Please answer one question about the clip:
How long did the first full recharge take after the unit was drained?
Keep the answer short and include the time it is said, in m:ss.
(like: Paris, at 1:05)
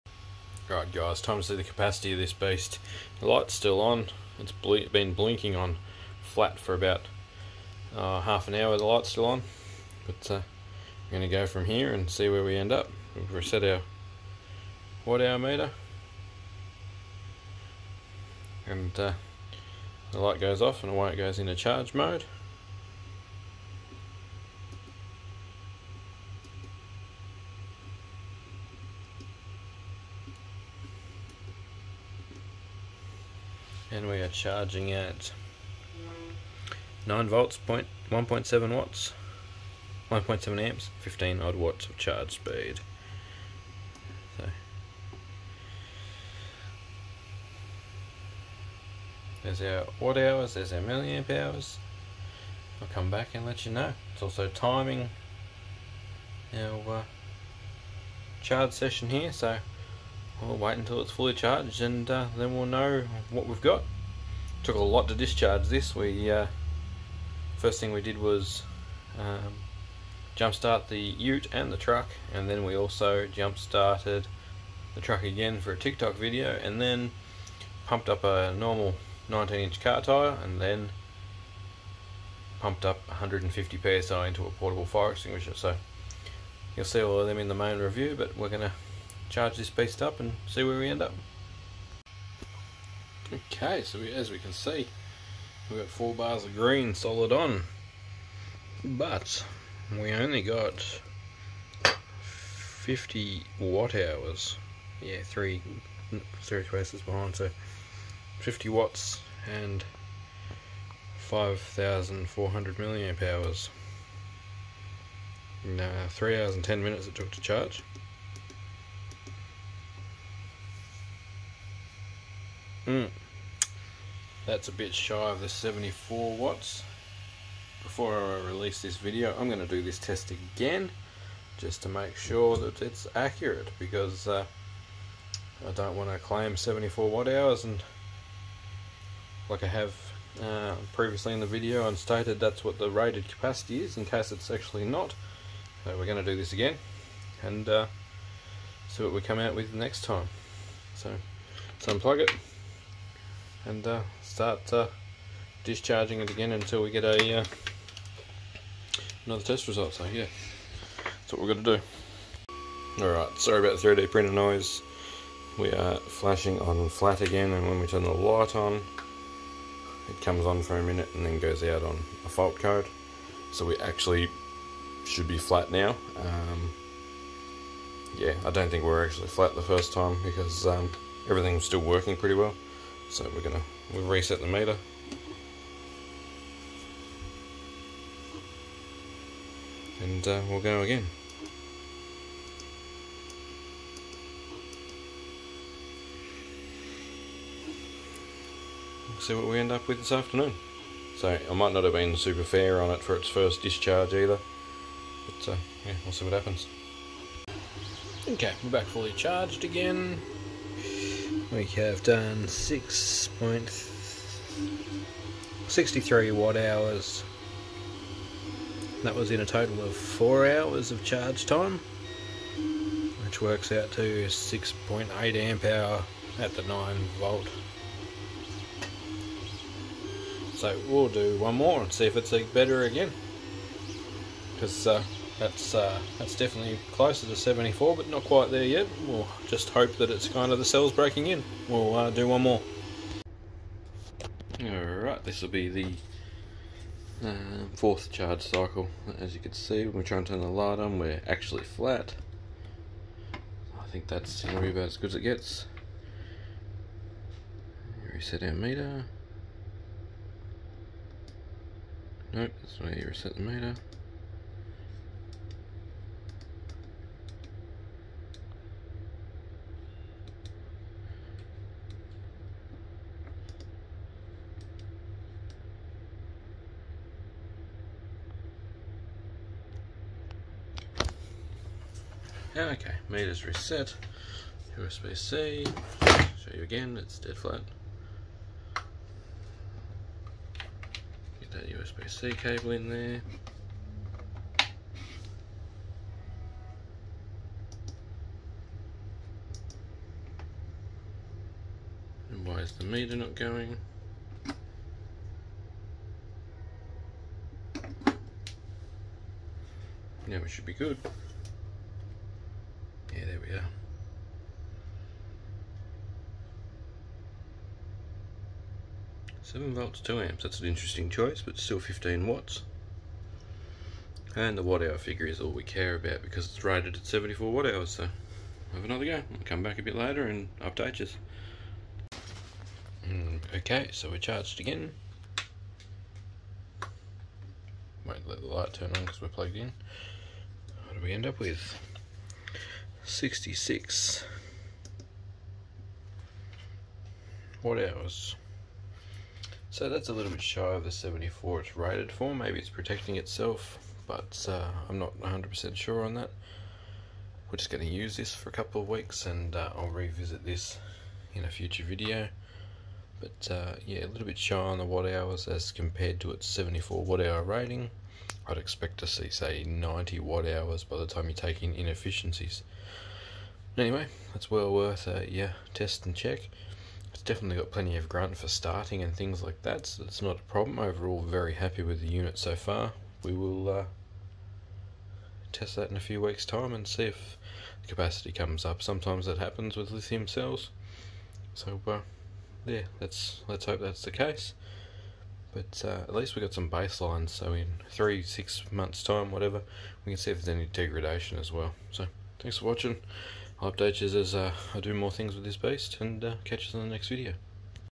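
3 hours 10 minutes, at 1:56.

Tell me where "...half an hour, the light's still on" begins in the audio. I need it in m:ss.
0:08.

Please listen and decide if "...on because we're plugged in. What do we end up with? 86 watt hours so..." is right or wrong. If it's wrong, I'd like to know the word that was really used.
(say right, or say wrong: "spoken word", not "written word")
wrong: "66", not "86".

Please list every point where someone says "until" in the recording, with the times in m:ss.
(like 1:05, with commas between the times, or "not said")
1:00, 2:36.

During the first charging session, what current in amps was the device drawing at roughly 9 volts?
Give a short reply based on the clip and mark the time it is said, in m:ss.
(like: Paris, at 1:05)
1.7 amps, at 0:40.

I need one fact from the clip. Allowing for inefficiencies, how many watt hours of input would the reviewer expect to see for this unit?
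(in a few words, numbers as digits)
90.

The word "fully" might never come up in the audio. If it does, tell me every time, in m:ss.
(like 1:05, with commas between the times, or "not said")
1:01, 3:28.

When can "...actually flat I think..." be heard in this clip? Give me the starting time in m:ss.
4:11.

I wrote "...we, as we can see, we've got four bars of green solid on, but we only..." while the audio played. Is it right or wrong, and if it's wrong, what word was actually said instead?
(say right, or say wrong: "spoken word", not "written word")
right.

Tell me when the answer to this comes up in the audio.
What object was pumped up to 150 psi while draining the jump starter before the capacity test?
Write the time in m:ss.
1:24.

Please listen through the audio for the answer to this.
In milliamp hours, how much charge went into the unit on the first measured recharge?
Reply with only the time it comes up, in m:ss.
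1:51.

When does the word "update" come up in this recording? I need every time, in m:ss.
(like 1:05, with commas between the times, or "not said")
5:30, 6:43.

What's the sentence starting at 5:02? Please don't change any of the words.
And why is the meter not going?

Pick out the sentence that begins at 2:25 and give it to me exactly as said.
So we're going to do this again and uh, see what we come out with next time.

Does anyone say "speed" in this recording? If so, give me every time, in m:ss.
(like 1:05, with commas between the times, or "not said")
0:42.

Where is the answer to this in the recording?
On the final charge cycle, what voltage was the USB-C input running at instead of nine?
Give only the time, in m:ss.
5:19.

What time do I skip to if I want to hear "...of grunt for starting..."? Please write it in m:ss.
6:17.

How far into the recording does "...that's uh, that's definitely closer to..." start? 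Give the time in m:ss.
3:55.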